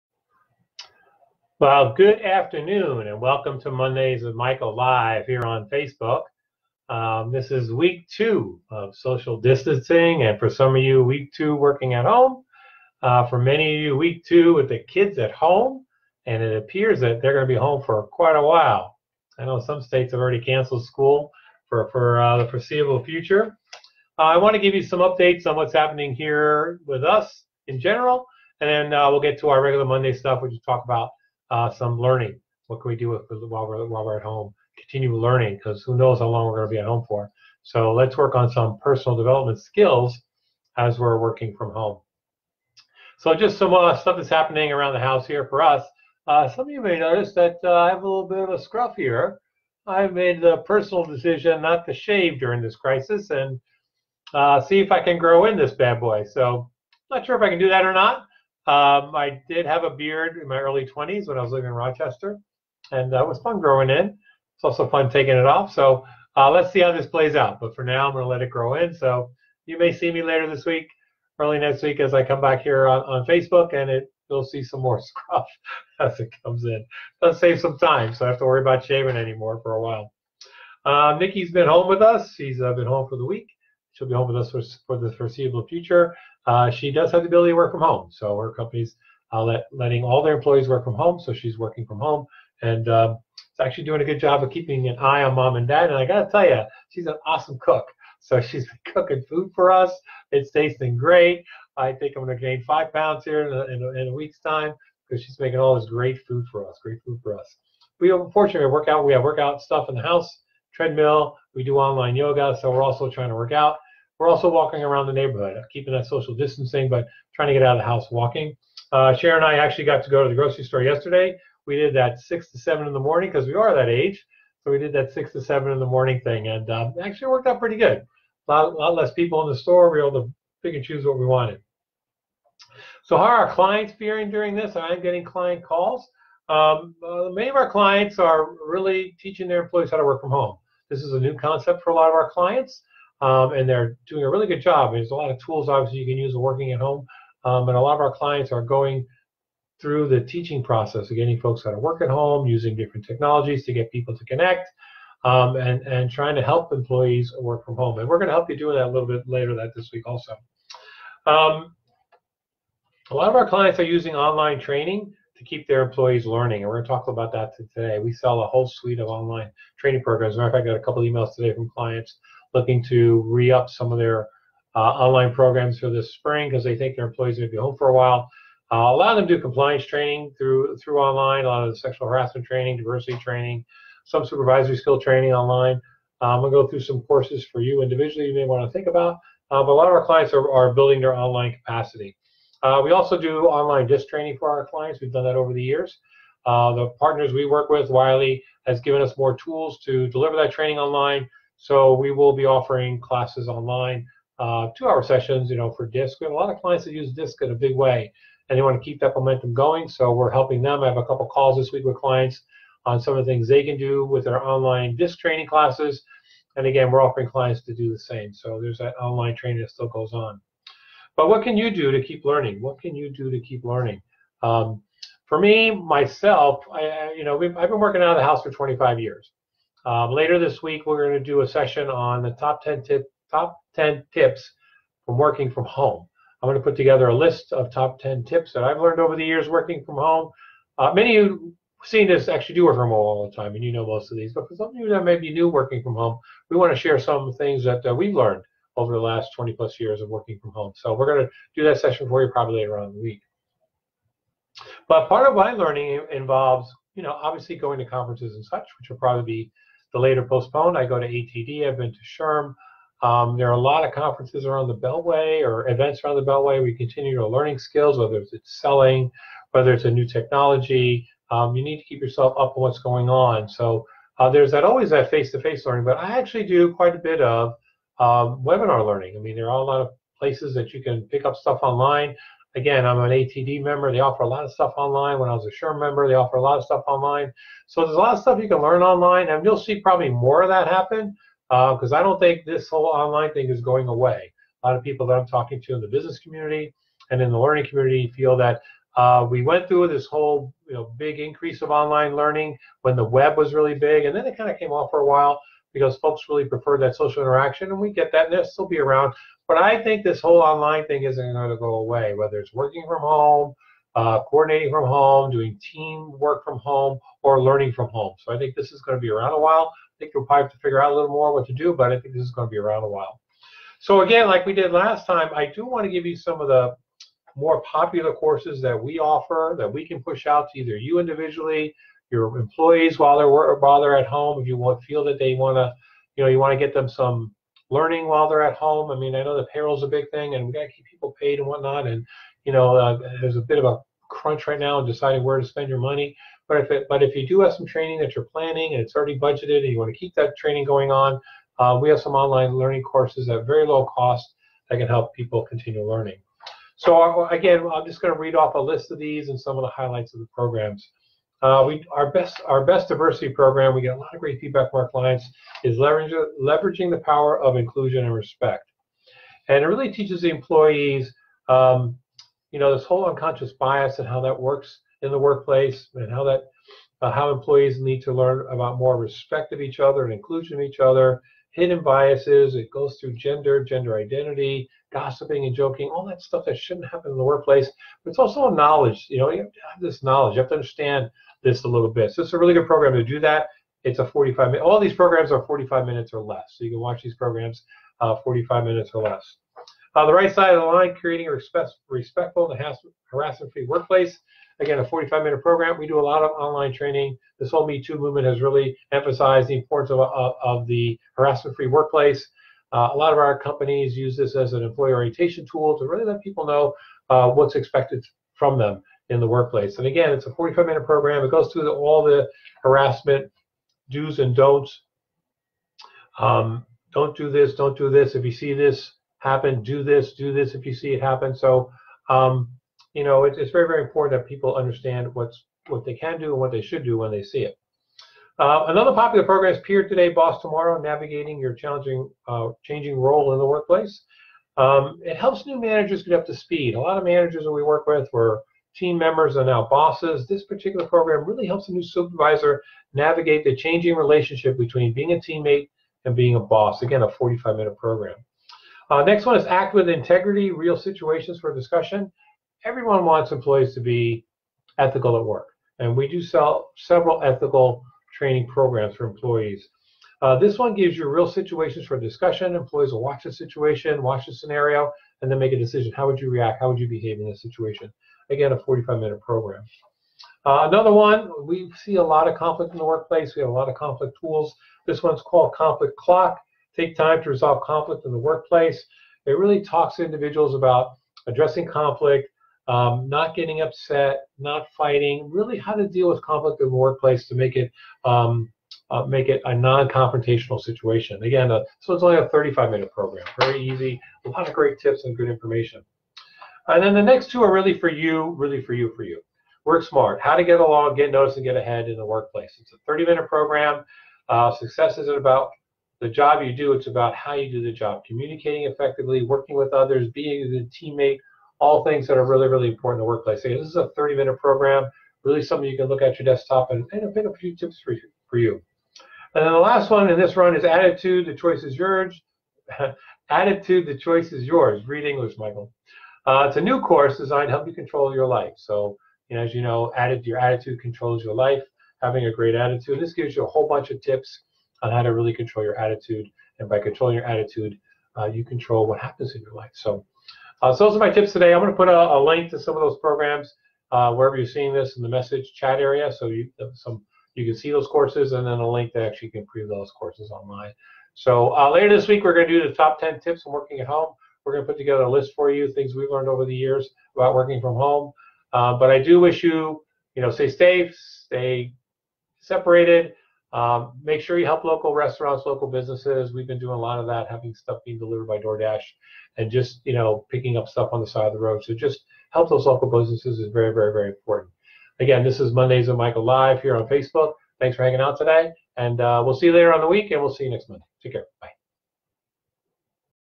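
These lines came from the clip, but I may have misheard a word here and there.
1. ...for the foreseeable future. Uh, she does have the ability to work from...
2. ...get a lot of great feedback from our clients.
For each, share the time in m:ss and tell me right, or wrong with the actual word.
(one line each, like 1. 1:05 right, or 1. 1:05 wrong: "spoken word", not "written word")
1. 1:24 right
2. 6:03 right.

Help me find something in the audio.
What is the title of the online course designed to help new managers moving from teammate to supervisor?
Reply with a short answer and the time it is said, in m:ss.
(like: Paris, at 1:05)
Peer Today, Boss Tomorrow, at 7:19.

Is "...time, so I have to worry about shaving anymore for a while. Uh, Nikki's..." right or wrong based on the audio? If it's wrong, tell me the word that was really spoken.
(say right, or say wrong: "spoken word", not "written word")
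right.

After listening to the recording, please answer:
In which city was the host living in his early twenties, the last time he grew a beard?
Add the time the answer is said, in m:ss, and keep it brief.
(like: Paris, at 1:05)
Rochester, at 1:01.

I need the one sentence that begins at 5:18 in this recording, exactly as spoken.
So I think this is going to be around a while.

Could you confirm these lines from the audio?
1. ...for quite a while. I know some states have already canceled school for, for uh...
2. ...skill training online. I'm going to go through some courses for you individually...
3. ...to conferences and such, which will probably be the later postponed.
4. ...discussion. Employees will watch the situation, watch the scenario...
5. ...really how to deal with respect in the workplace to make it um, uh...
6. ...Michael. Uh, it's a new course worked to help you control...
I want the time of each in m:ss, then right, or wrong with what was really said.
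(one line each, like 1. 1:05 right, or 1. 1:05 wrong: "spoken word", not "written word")
1. 0:17 right
2. 3:04 right
3. 4:17 right
4. 7:51 right
5. 8:15 wrong: "conflict", not "respect"
6. 8:55 wrong: "designed", not "worked".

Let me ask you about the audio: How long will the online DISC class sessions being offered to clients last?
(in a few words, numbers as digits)
2 hours.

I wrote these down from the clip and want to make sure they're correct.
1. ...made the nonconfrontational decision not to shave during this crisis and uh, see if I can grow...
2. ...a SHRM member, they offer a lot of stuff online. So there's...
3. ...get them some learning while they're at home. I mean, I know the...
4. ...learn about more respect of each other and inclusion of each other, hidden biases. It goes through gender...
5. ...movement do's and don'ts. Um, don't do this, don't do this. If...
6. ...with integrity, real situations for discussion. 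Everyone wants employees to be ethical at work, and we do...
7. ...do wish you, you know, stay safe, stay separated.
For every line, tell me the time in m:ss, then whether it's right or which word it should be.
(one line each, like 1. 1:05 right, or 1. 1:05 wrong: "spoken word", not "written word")
1. 0:50 wrong: "personal", not "nonconfrontational"
2. 4:45 right
3. 5:36 right
4. 6:18 right
5. 7:02 wrong: "harassment", not "movement"
6. 7:39 right
7. 9:29 right.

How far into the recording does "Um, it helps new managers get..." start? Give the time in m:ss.
7:24.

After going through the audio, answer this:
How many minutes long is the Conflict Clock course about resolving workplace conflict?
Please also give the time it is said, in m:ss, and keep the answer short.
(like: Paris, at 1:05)
35, at 8:22.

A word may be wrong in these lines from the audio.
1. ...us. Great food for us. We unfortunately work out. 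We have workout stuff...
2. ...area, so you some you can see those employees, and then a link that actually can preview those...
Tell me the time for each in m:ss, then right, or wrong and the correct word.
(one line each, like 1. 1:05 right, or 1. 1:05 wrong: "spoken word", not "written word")
1. 1:46 right
2. 9:15 wrong: "courses", not "employees".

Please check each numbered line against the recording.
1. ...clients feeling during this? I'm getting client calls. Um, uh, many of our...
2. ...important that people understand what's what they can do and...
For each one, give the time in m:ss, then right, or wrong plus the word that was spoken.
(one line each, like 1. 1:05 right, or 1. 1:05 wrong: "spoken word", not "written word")
1. 2:13 right
2. 7:13 right.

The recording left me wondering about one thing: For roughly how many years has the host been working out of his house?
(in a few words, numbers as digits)
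25.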